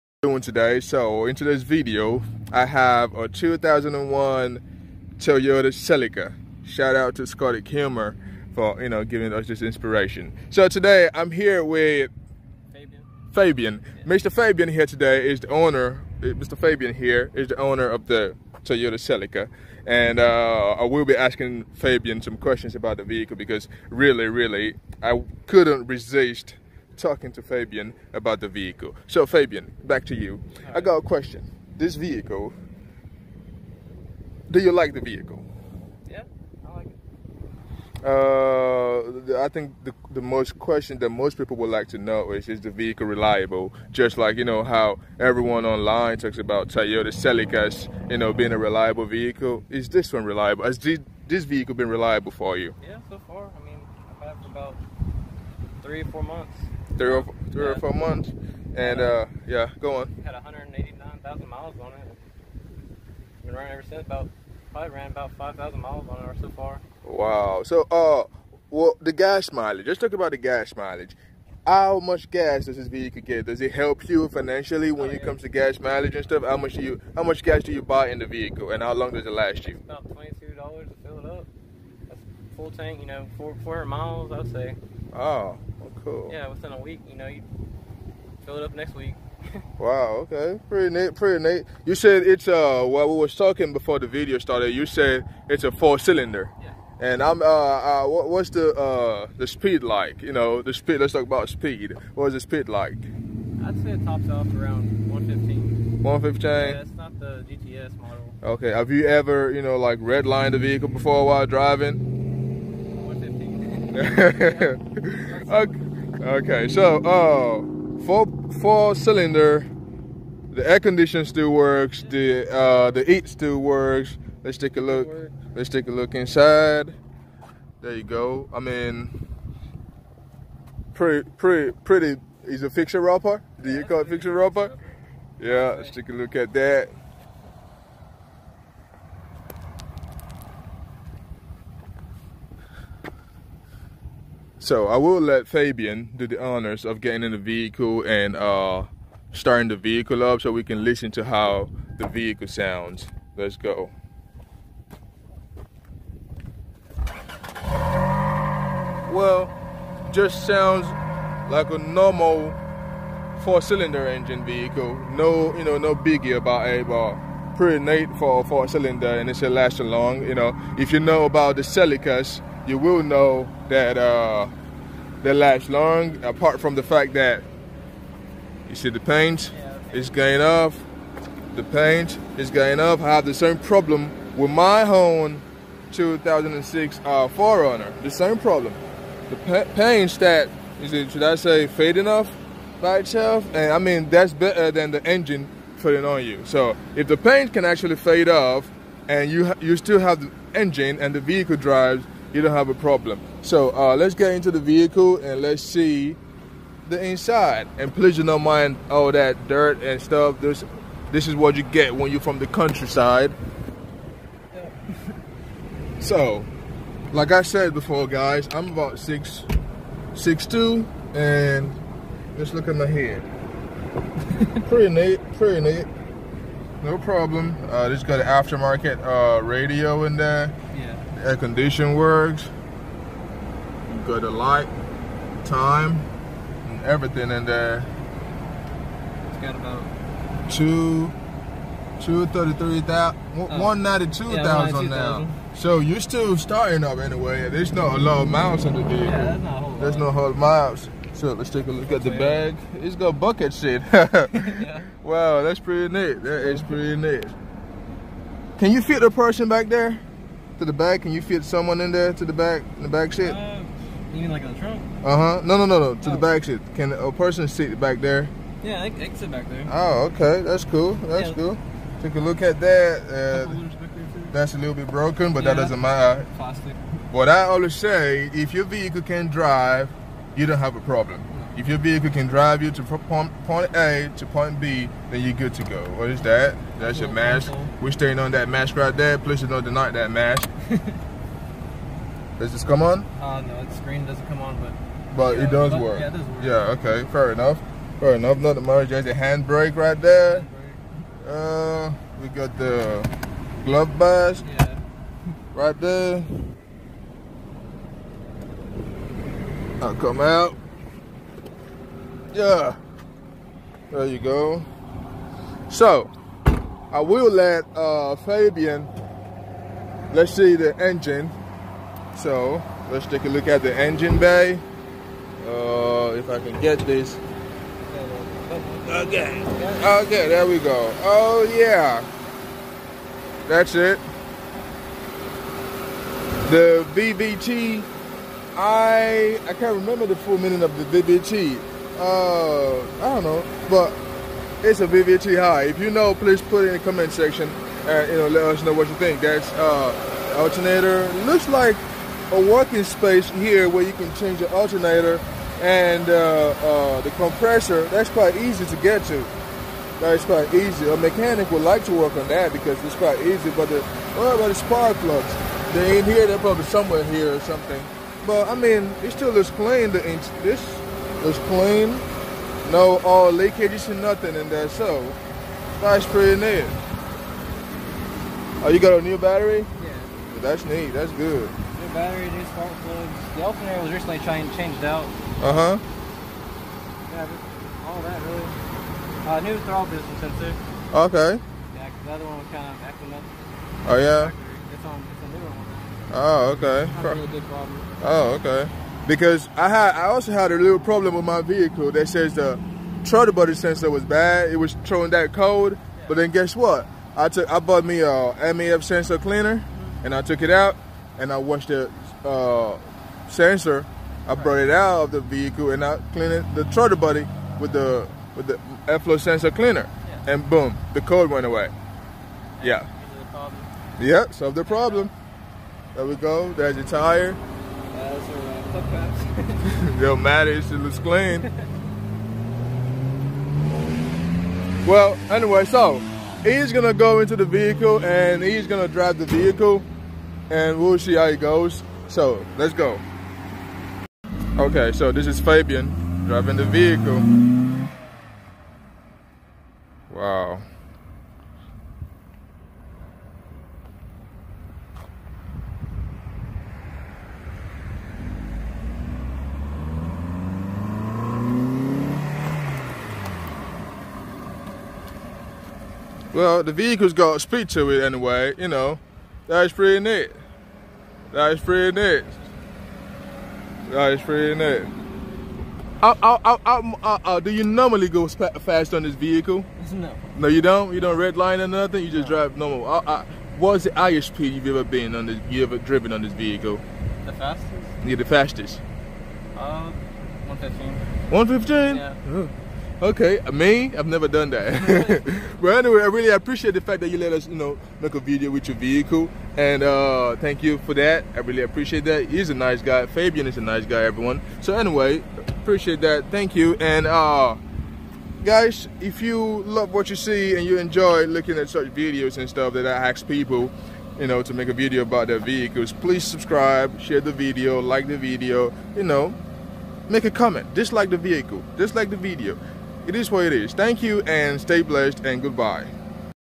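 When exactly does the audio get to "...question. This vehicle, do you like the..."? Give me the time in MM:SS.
00:31.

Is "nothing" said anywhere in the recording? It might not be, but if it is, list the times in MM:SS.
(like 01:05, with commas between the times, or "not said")
06:14, 08:01.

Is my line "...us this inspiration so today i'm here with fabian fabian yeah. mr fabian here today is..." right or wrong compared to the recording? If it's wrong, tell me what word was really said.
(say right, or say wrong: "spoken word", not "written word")
right.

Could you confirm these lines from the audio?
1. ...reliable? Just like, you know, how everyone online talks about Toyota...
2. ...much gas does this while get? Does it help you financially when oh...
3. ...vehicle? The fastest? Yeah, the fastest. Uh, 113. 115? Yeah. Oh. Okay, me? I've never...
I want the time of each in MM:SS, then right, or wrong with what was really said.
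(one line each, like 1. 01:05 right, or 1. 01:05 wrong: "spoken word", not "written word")
1. 00:43 right
2. 01:11 wrong: "vehicle", not "while"
3. 08:06 wrong: "115", not "113".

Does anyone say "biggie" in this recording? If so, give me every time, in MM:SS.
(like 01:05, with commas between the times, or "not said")
02:45.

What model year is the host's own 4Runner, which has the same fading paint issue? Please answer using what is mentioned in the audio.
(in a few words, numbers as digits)
2006.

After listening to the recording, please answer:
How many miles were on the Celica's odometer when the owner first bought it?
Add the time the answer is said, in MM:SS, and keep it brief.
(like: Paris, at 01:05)
189,000, at 01:00.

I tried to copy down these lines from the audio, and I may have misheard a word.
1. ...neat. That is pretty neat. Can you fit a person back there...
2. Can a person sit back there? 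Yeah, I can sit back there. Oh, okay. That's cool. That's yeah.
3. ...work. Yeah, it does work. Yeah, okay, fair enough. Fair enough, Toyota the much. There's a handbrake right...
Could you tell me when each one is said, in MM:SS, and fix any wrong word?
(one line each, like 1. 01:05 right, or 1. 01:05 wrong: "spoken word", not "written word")
1. 04:15 right
2. 04:26 right
3. 04:55 wrong: "Not", not "Toyota".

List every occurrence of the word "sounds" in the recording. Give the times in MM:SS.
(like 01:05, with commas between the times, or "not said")
02:32, 02:40.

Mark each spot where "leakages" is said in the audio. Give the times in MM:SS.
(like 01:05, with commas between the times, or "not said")
06:13.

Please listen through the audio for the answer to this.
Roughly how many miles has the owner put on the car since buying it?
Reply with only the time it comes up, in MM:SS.
01:05.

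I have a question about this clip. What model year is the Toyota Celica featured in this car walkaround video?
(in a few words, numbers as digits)
2001.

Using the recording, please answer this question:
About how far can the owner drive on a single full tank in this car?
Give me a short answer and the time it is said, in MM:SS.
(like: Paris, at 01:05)
400 miles, at 01:23.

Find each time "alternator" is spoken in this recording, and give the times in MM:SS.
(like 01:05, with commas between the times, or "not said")
05:50, 05:54.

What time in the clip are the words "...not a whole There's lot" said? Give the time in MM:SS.
04:09.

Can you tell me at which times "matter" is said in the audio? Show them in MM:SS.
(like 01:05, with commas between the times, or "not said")
04:35, 07:10.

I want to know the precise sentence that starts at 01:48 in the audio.
Okay, have you ever, you know, like redlined the vehicle before while driving?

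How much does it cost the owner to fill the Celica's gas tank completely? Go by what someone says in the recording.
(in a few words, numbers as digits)
$22.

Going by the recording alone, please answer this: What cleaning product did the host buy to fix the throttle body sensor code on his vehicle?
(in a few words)
MAF sensor cleaner.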